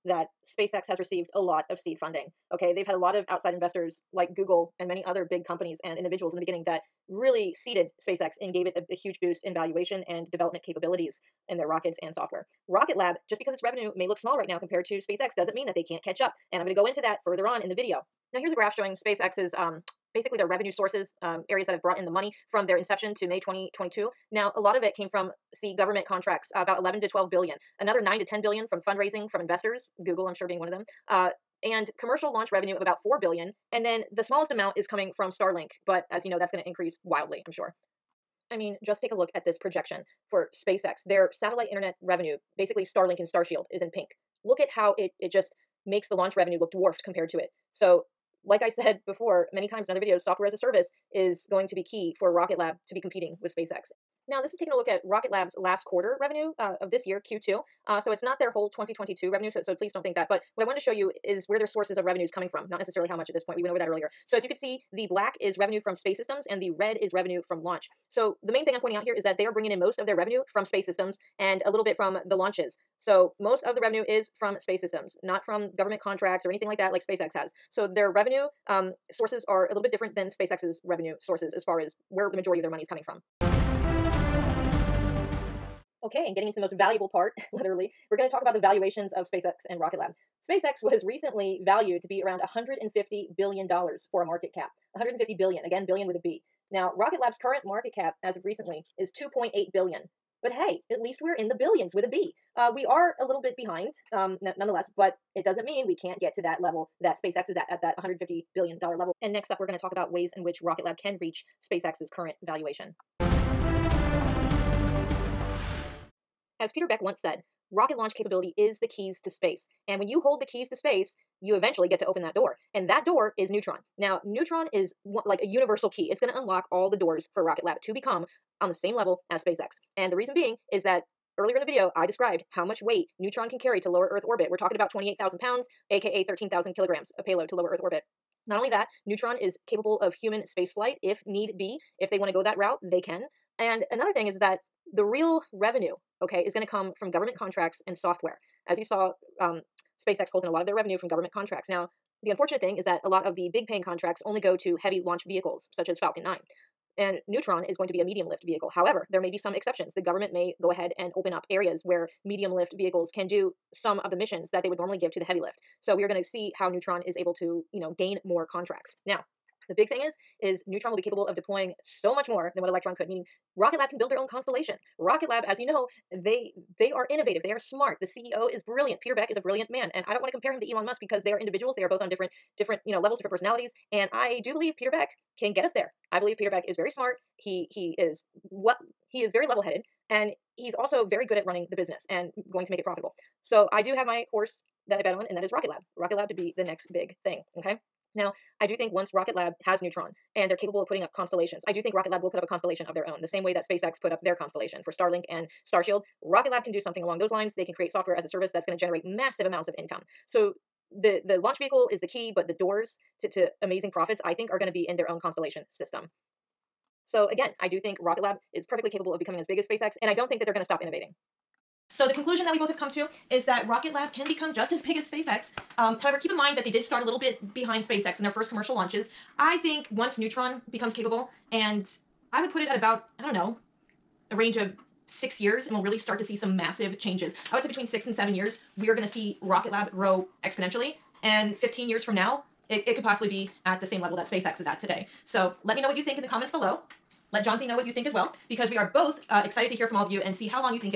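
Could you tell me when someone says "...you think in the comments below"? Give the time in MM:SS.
04:05.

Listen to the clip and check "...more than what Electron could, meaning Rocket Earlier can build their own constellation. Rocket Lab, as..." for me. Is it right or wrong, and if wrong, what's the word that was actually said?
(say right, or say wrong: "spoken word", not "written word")
wrong: "Lab", not "Earlier".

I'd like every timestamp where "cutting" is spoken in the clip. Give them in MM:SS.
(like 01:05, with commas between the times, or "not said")
not said.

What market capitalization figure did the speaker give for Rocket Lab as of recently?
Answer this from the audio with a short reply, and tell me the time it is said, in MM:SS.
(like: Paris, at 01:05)
2.8 billion, at 01:39.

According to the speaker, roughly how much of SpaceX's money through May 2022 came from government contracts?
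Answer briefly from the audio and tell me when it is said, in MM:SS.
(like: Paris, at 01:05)
11 to 12 billion, at 00:26.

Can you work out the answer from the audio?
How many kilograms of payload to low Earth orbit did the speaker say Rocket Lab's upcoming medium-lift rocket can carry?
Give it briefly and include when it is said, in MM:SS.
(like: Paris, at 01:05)
13,000 kilograms, at 02:16.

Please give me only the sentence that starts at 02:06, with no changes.
It's going to unlock all the doors for Rocket Lab to become on the same level as SpaceX.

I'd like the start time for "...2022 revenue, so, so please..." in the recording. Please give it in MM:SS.
00:58.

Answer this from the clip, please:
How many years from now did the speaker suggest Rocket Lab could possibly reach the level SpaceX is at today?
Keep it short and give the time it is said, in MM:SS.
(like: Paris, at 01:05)
15 years, at 04:01.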